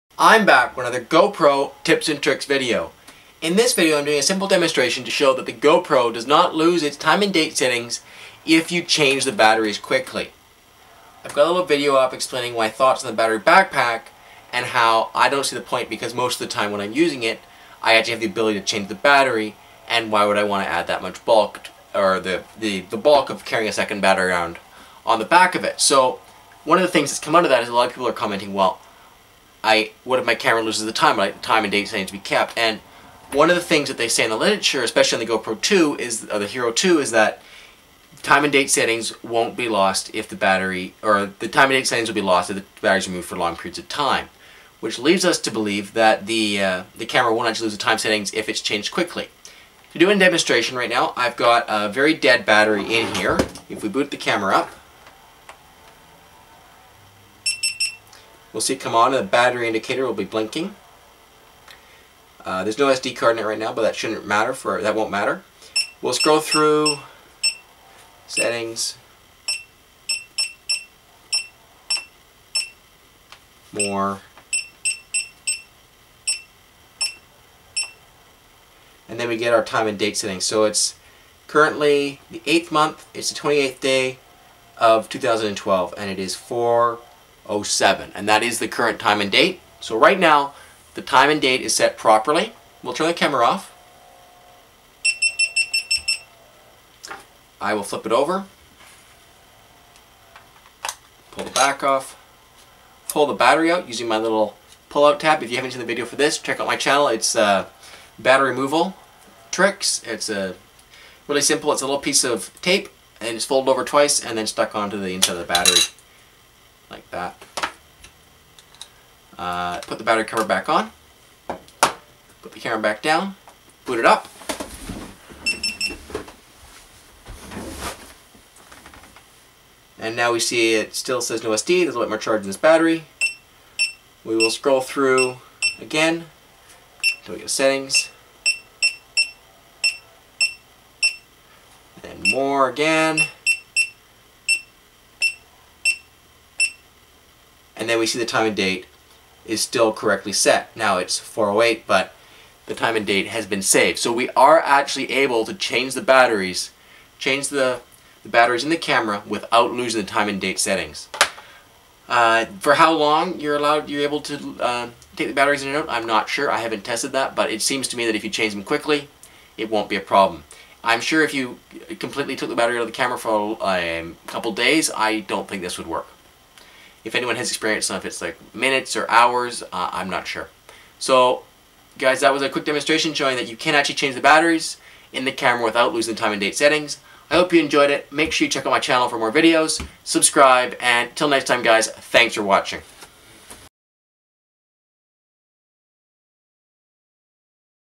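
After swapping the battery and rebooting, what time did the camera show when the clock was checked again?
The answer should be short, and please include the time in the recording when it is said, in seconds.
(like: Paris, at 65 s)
4:08, at 151 s.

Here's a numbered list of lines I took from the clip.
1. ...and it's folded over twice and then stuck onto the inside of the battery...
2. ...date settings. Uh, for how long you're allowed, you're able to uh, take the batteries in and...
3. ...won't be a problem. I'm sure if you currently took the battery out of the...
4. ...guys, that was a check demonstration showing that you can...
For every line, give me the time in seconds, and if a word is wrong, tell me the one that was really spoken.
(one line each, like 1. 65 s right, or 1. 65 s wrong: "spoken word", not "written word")
1. 113 s right
2. 160 s right
3. 169 s wrong: "completely", not "currently"
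4. 181 s wrong: "quick", not "check".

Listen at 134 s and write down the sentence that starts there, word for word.
We will scroll through again until we get settings.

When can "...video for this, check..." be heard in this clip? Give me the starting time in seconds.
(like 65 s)
105 s.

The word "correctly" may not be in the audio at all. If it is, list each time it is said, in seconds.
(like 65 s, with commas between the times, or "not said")
149 s.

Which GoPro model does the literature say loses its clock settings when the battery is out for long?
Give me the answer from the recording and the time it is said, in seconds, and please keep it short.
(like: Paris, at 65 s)
Hero 2, at 36 s.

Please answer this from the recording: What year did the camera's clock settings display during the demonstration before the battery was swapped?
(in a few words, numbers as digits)
2012.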